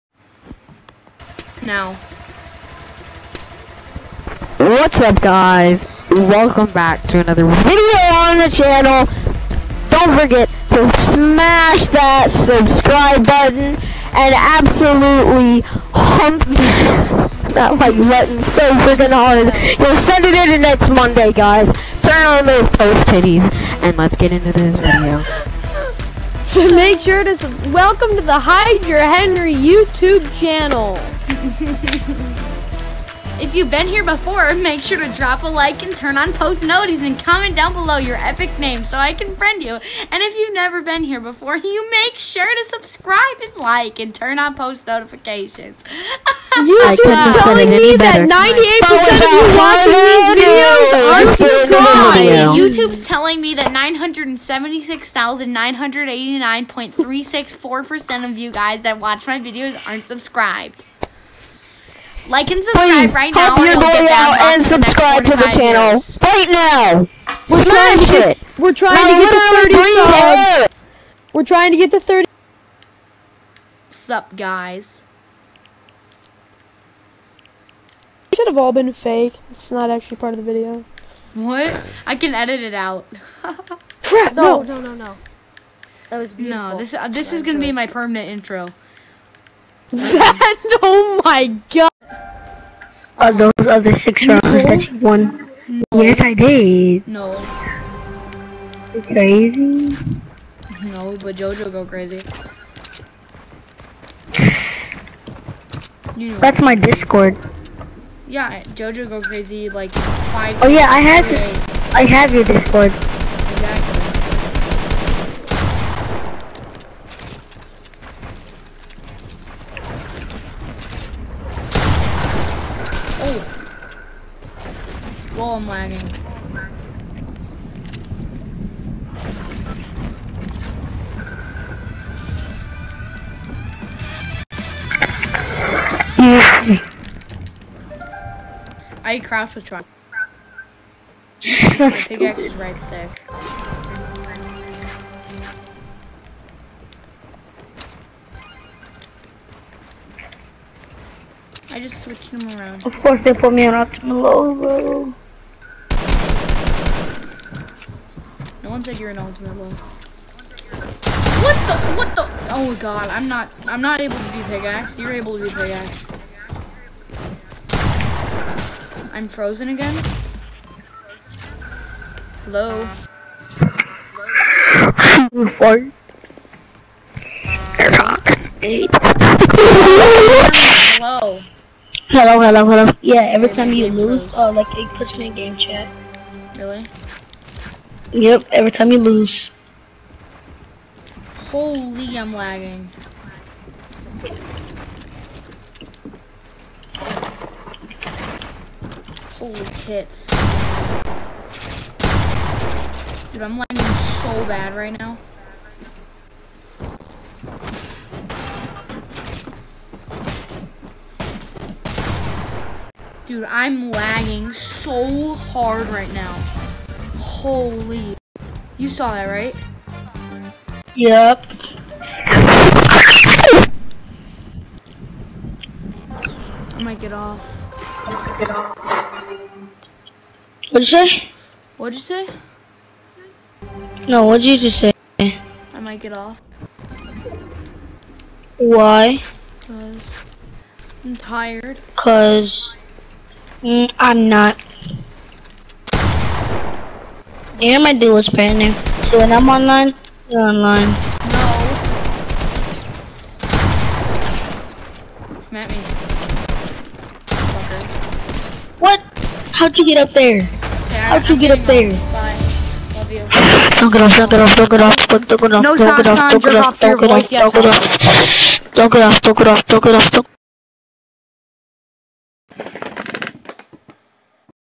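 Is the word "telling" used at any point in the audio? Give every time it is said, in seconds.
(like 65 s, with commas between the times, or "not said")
47 s, 53 s.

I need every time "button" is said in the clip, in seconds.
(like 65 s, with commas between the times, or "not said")
13 s, 18 s.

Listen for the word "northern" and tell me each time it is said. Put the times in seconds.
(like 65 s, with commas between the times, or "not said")
not said.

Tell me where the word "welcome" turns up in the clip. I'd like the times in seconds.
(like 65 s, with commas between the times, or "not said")
6 s, 27 s.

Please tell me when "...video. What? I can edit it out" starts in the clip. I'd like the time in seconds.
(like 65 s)
80 s.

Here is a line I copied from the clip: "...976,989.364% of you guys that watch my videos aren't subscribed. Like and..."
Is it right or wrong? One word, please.
right.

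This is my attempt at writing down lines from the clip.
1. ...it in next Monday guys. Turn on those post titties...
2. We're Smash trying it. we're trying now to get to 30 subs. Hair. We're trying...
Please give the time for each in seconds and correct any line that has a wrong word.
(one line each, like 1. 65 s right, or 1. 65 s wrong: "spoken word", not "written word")
1. 20 s right
2. 67 s right.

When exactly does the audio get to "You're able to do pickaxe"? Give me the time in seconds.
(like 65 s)
164 s.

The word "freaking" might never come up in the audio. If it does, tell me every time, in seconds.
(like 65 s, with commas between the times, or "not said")
18 s.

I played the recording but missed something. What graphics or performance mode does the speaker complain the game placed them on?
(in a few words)
Optimal low.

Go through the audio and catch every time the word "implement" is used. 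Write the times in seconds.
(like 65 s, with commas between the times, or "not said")
not said.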